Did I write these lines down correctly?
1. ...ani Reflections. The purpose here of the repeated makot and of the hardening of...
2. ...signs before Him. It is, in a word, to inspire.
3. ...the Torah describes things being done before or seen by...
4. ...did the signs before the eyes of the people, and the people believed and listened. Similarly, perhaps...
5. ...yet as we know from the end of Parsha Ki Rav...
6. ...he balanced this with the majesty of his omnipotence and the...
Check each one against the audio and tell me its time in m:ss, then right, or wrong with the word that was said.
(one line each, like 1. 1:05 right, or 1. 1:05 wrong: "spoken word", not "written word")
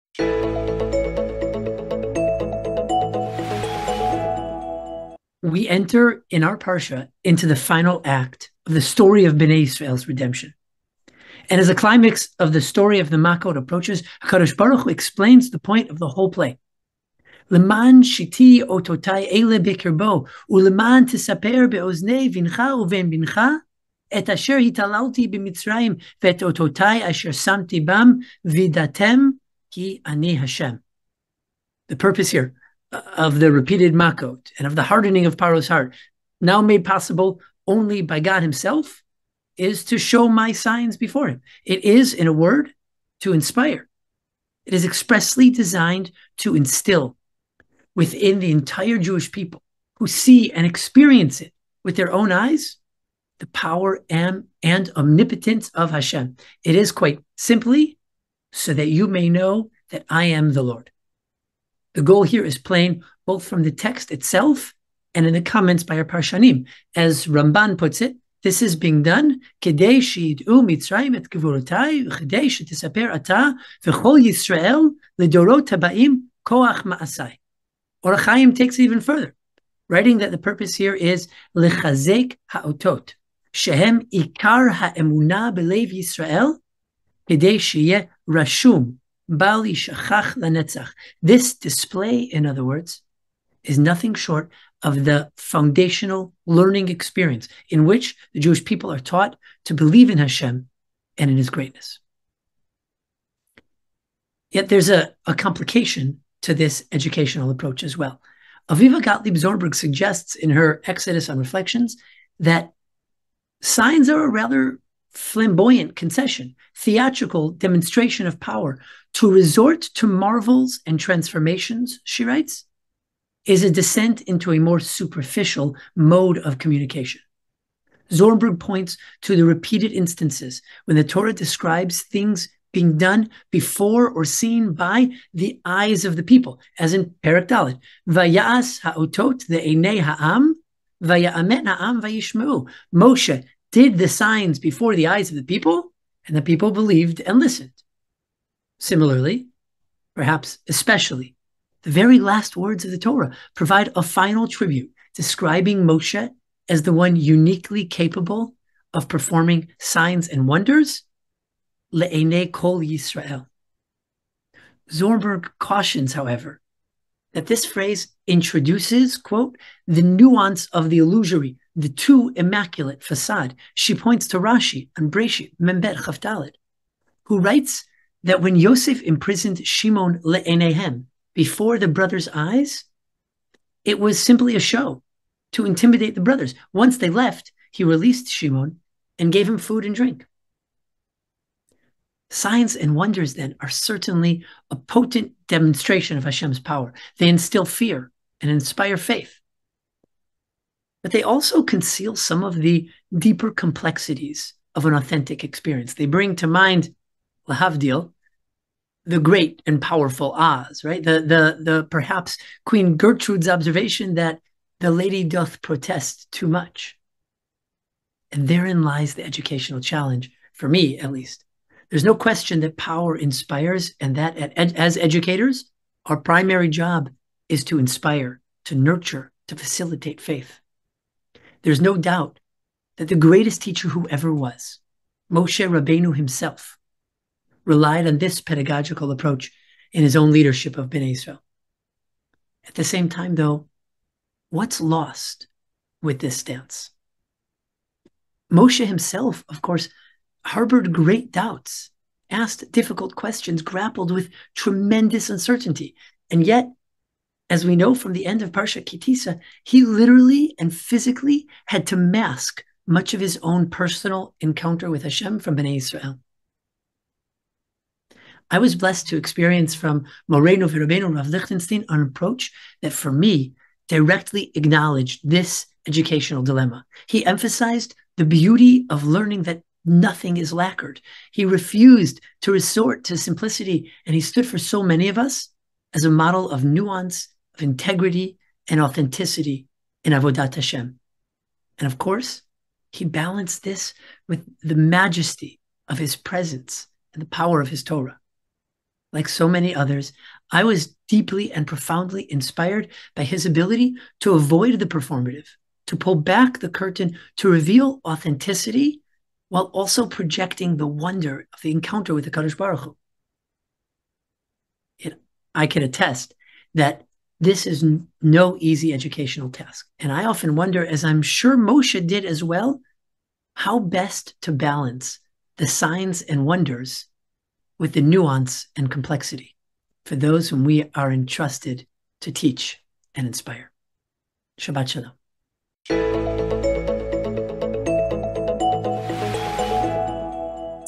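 1. 0:30 wrong: "Hashem", not "Reflections"
2. 0:40 right
3. 2:10 right
4. 2:23 right
5. 4:16 wrong: "Tisa", not "Rav"
6. 4:52 wrong: "presence", not "omnipotence".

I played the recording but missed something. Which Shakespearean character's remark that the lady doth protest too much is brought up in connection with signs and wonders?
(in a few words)
Queen Gertrude.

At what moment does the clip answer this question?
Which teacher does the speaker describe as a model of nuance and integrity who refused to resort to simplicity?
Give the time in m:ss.
4:31.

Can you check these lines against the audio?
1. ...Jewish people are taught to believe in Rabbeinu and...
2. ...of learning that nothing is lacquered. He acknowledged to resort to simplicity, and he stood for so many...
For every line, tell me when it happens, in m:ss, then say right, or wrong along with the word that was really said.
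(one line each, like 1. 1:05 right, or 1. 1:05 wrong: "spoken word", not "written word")
1. 1:38 wrong: "Hashem", not "Rabbeinu"
2. 4:38 wrong: "refused", not "acknowledged".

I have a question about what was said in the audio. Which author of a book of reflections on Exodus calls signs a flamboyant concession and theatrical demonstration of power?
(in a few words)
Aviva Gottlieb Zornberg.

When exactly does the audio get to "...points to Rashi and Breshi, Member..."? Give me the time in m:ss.
2:53.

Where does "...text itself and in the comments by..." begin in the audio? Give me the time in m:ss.
1:03.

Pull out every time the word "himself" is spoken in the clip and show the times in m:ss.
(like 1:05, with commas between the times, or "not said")
0:38, 3:56, 4:08.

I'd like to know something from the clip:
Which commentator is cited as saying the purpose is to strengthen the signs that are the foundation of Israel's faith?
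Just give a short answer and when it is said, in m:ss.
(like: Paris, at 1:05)
Or Chaim, at 1:18.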